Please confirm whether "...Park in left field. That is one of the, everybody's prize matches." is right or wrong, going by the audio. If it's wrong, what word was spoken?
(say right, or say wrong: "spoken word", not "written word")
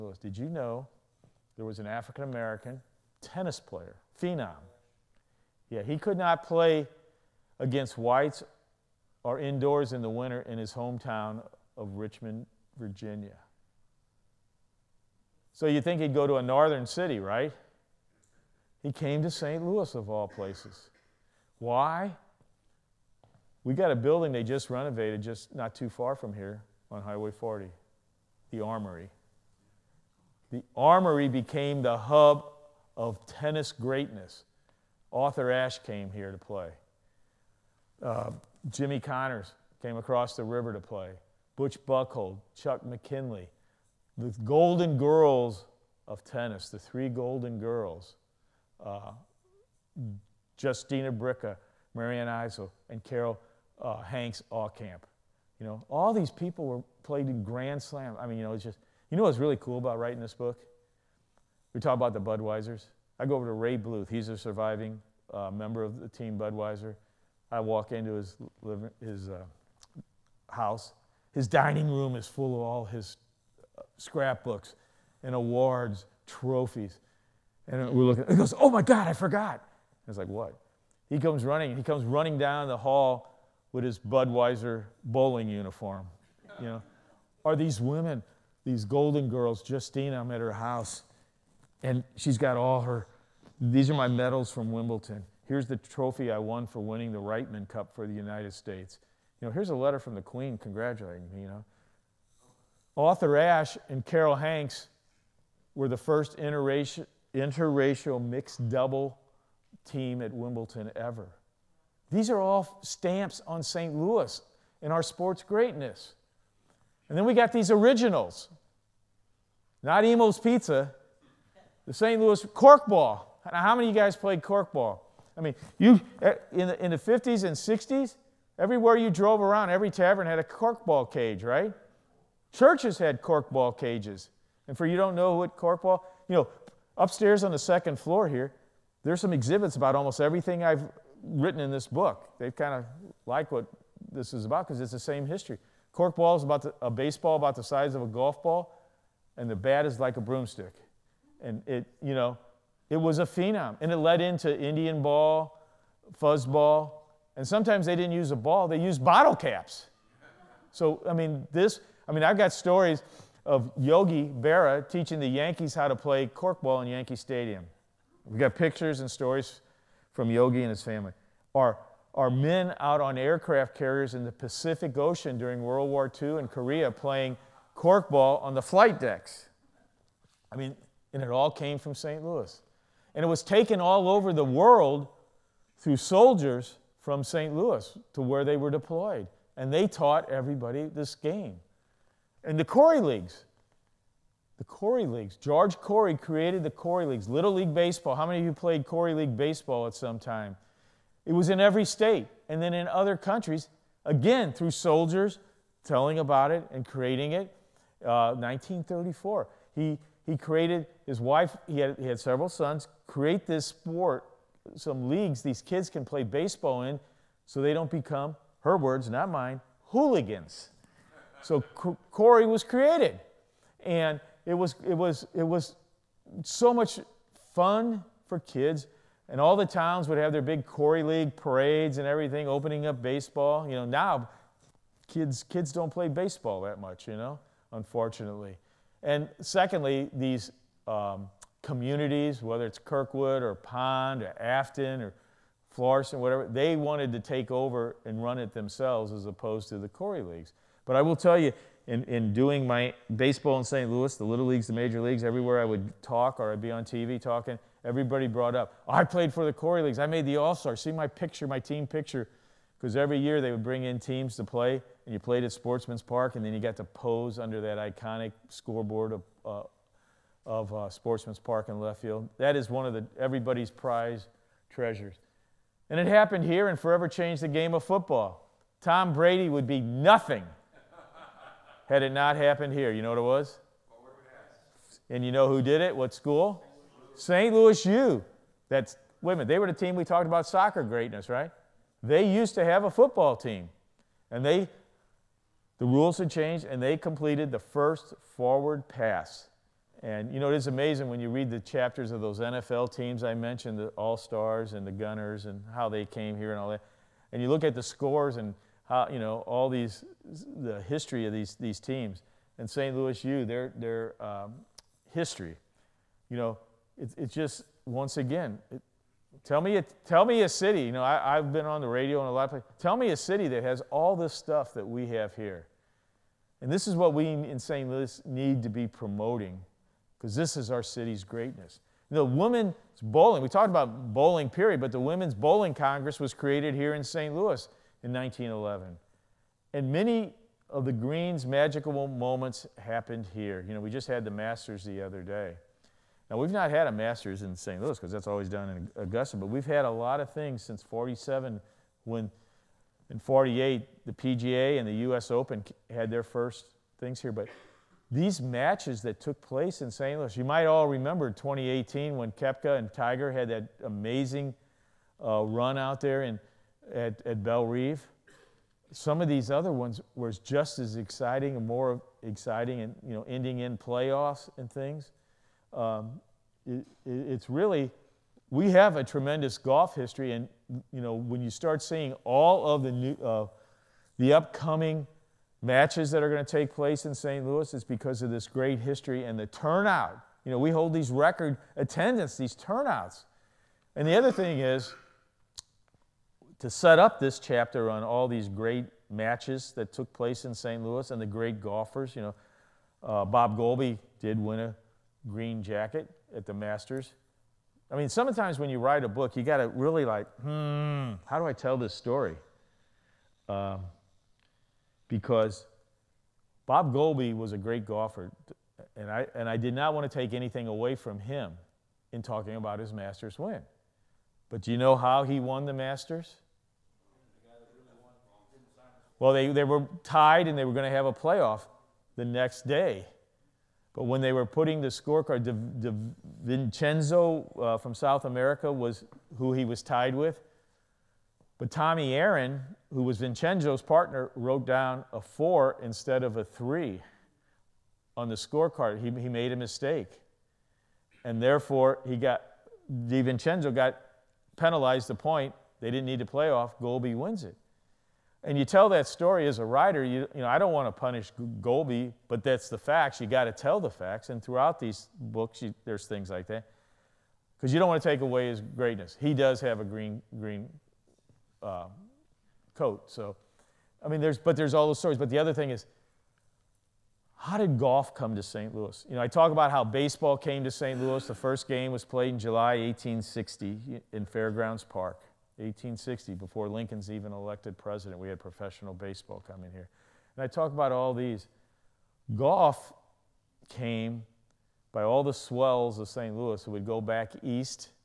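wrong: "treasures", not "matches".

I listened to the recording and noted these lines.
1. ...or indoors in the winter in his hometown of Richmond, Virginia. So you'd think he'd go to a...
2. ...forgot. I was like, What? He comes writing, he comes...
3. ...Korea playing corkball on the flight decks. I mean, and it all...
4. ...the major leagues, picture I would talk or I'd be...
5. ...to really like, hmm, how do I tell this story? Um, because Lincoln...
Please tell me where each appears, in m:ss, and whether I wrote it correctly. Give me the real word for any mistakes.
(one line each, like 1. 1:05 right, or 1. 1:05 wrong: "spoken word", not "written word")
1. 0:09 right
2. 1:19 wrong: "running", not "writing"
3. 2:56 right
4. 4:14 wrong: "everywhere", not "picture"
5. 6:49 wrong: "Bob", not "Lincoln".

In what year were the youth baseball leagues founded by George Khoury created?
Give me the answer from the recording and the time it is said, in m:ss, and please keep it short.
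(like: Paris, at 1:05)
1934, at 3:28.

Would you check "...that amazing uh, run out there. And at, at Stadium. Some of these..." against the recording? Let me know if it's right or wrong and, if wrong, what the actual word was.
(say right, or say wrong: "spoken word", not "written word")
wrong: "Bellerive", not "Stadium".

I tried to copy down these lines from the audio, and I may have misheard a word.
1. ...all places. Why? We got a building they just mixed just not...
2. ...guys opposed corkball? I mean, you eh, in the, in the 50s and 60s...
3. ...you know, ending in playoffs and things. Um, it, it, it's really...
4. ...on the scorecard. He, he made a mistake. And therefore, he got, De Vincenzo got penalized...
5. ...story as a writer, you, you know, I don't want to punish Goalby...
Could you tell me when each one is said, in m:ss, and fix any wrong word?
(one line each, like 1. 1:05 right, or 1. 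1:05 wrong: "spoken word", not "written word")
1. 0:20 wrong: "renovated", not "mixed"
2. 2:04 wrong: "played", not "opposed"
3. 6:13 right
4. 7:28 right
5. 7:39 right.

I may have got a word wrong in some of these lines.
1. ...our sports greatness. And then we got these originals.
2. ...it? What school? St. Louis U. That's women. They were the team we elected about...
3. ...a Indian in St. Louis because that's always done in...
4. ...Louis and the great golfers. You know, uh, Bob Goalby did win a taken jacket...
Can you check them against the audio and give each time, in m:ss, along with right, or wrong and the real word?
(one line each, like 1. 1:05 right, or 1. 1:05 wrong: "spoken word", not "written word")
1. 1:54 right
2. 4:45 wrong: "talked", not "elected"
3. 5:46 wrong: "Masters", not "Indian"
4. 6:40 wrong: "green", not "taken".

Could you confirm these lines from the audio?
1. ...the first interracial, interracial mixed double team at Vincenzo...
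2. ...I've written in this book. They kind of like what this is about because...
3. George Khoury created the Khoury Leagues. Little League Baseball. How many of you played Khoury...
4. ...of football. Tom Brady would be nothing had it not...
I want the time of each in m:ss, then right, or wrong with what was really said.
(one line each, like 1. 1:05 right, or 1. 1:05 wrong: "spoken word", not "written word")
1. 1:45 wrong: "Wimbledon", not "Vincenzo"
2. 2:20 right
3. 3:15 right
4. 4:37 right.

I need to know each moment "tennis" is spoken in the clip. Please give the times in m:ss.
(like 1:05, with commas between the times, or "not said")
0:03, 0:33, 0:46.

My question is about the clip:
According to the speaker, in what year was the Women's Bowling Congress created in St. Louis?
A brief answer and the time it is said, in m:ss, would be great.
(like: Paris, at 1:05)
1911, at 5:38.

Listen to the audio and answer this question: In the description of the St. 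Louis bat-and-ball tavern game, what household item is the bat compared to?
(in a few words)
A broomstick.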